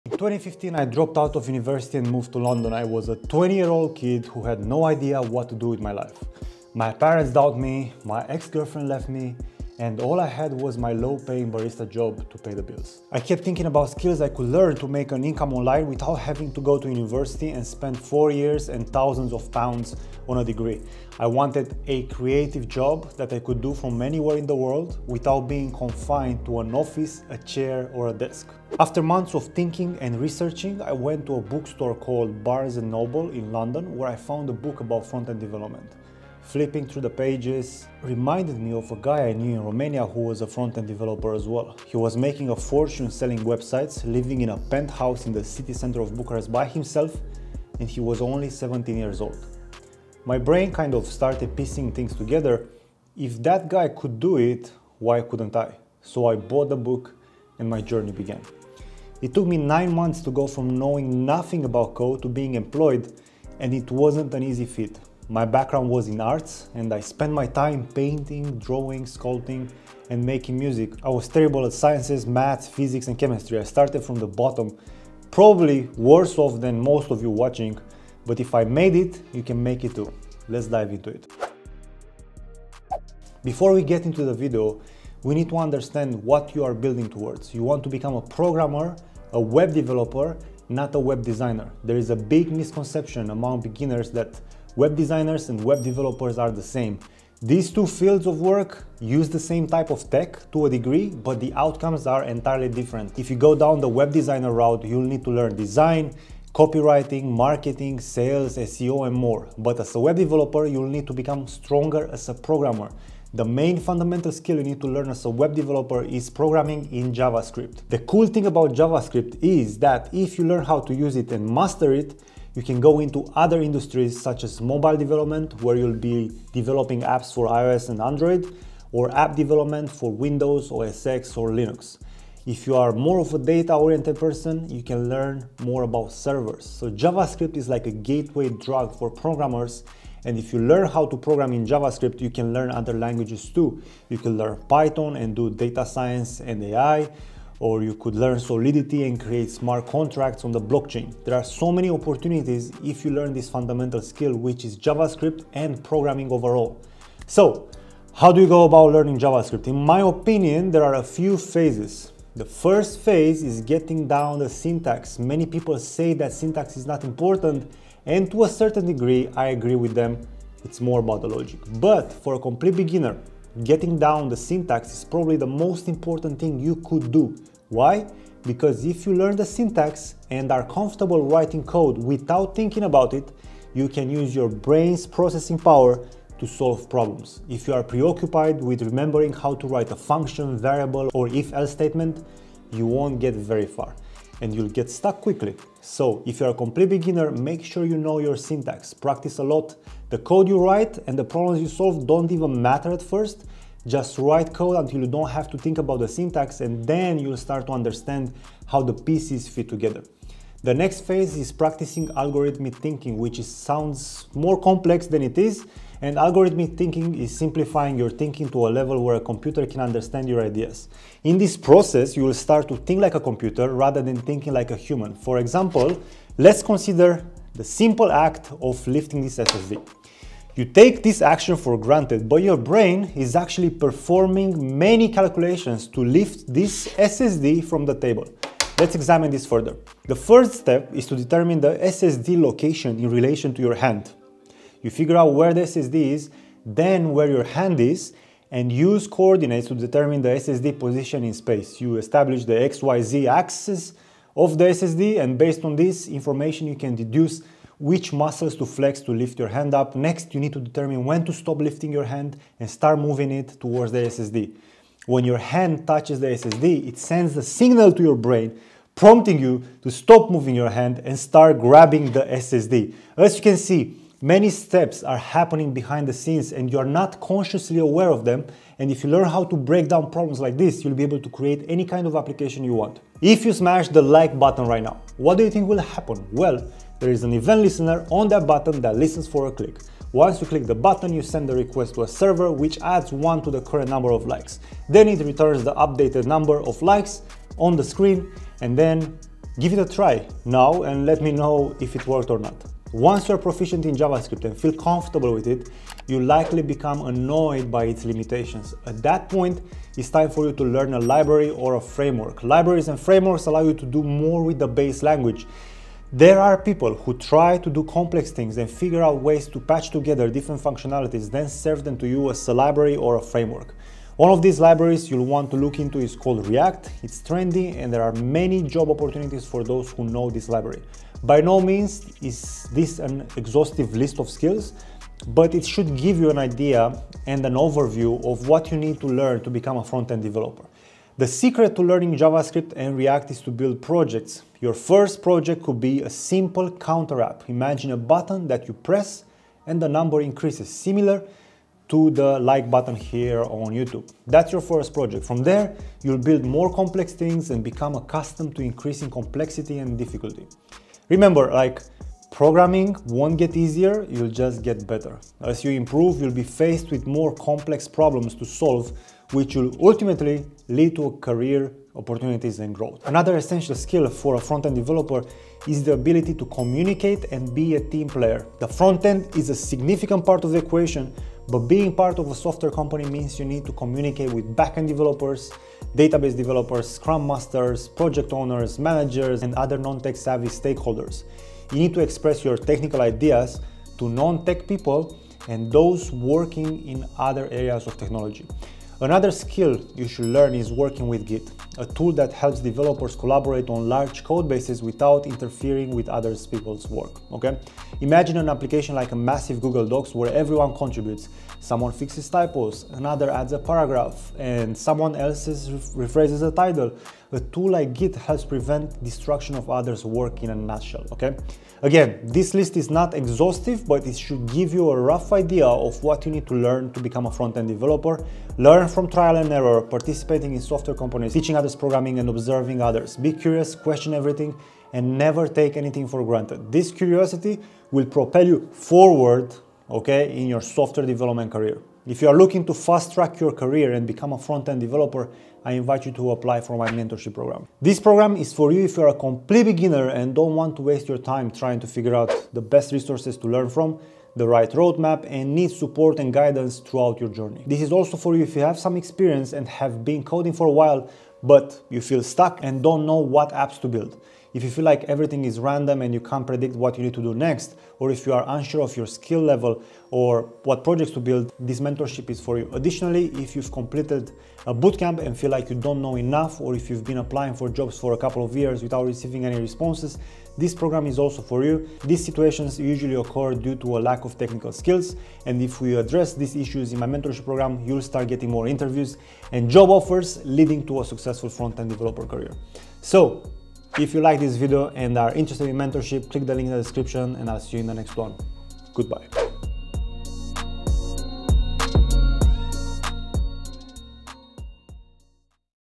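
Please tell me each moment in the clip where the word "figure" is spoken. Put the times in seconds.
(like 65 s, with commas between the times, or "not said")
244 s, 318 s, 451 s.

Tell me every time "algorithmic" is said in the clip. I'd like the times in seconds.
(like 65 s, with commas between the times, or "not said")
212 s, 216 s.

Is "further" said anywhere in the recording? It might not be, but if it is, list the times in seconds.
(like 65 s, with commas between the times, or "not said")
239 s.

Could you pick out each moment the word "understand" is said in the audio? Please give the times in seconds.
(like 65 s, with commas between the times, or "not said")
85 s, 207 s, 219 s.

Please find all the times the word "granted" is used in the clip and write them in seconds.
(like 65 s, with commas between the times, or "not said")
231 s, 436 s.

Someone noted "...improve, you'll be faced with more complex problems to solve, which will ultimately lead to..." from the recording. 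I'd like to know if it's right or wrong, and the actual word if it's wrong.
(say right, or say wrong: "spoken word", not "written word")
right.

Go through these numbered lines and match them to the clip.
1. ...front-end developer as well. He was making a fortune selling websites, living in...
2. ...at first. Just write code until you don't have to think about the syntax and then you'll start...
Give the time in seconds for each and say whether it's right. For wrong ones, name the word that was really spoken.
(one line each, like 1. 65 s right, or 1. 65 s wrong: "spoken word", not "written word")
1. 40 s right
2. 202 s right.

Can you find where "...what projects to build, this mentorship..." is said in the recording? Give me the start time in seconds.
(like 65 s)
470 s.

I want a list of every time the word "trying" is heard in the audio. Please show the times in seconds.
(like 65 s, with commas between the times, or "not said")
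451 s.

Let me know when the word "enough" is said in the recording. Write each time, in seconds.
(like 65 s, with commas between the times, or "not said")
476 s.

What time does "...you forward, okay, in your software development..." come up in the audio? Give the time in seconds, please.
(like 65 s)
438 s.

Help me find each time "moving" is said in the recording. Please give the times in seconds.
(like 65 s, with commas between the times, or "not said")
262 s, 270 s.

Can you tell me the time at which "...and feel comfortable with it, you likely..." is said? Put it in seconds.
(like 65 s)
304 s.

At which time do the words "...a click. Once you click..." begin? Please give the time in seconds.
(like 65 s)
289 s.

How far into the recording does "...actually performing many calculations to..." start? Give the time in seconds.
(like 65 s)
233 s.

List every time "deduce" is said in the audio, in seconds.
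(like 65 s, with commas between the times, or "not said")
256 s.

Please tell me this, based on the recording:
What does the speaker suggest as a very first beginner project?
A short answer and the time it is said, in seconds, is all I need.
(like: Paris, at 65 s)
counter app, at 346 s.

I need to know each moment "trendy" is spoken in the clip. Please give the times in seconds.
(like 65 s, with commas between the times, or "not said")
327 s.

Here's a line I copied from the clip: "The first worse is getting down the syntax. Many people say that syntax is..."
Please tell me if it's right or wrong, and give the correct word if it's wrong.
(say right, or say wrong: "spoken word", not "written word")
wrong: "phase", not "worse".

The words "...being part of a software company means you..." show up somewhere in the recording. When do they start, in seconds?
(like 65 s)
381 s.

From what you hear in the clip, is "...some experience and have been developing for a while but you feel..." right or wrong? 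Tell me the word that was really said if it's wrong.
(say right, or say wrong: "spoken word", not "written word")
wrong: "coding", not "developing".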